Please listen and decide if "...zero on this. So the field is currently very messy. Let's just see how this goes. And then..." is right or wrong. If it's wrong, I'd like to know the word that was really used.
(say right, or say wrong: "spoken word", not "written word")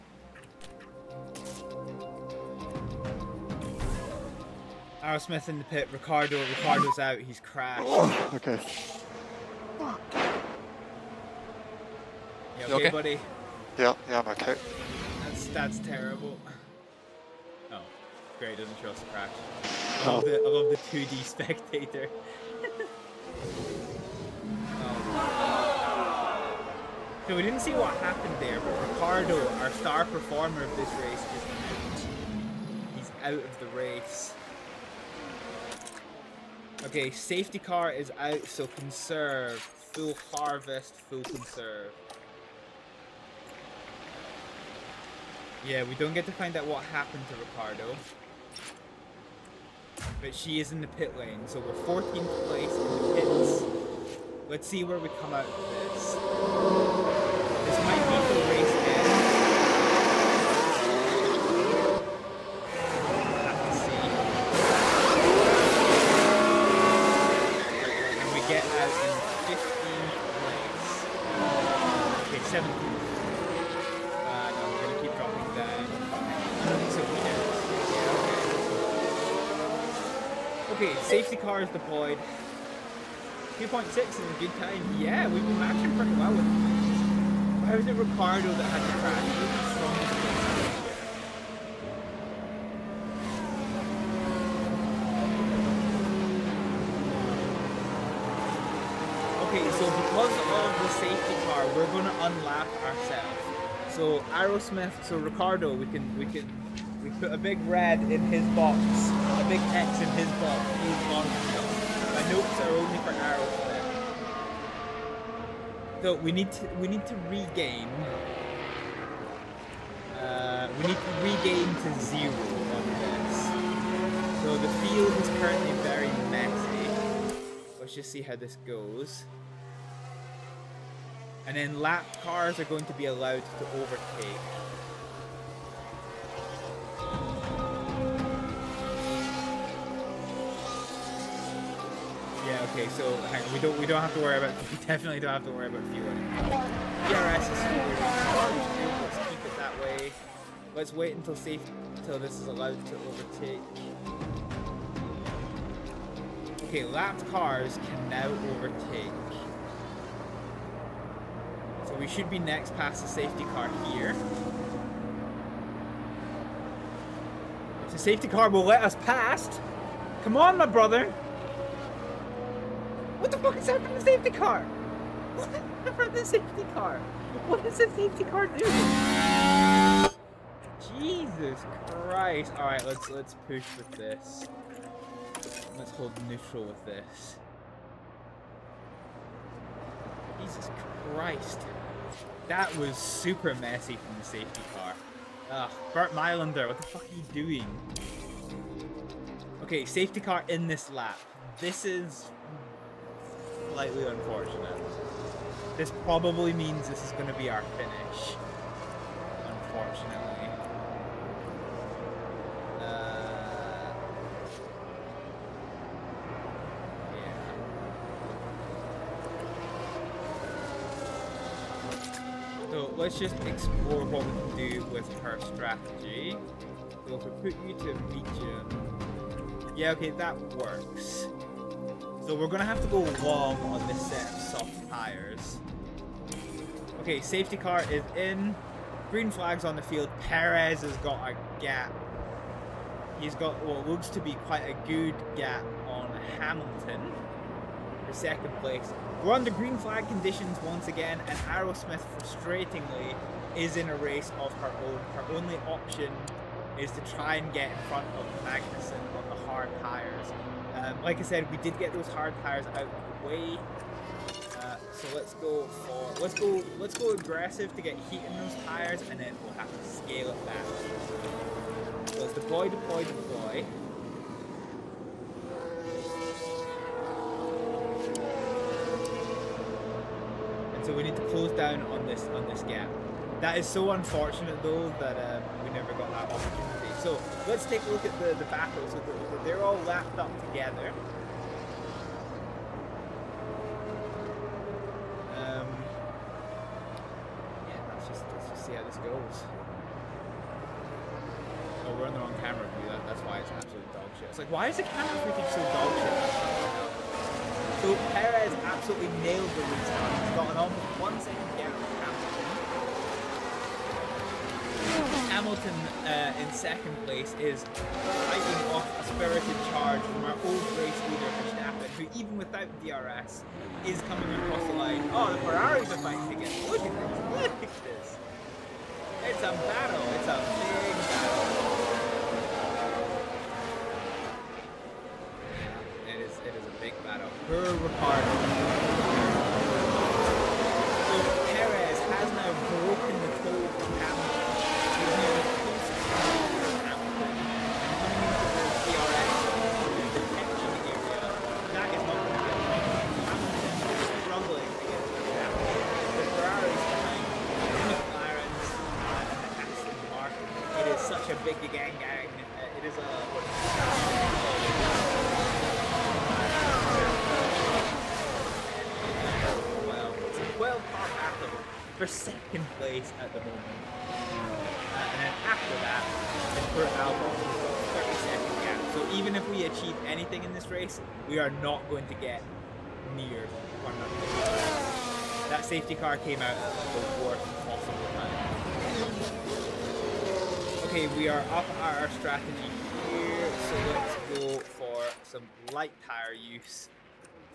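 right.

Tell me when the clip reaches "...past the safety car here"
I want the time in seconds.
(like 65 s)
162 s.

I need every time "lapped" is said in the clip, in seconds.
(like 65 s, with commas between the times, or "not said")
156 s, 289 s.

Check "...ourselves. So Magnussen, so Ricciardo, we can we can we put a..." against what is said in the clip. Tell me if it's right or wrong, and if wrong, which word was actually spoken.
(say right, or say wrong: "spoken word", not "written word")
wrong: "Arrowsmith", not "Magnussen".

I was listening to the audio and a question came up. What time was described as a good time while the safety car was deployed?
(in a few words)
2.6.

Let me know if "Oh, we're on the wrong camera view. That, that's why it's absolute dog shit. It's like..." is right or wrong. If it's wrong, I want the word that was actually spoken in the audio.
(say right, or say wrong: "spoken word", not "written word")
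right.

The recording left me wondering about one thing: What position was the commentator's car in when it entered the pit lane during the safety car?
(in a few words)
14th.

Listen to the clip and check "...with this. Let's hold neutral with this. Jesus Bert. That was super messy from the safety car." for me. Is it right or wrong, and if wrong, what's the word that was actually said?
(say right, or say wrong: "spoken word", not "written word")
wrong: "Christ", not "Bert".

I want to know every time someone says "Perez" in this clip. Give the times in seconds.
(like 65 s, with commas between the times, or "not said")
240 s, 308 s.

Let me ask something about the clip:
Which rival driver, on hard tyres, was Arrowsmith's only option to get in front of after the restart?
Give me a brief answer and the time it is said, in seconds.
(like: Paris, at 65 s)
Magnussen, at 258 s.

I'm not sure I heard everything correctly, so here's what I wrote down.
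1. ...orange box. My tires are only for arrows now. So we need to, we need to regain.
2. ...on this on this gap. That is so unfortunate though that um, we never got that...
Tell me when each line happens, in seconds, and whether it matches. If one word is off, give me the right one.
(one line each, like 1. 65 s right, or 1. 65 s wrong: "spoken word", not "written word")
1. 111 s wrong: "notes", not "tires"
2. 281 s right.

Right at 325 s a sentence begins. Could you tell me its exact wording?
Oh, the Ferraris are fighting again.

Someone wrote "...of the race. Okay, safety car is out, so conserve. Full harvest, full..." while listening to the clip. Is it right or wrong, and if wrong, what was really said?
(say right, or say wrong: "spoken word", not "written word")
right.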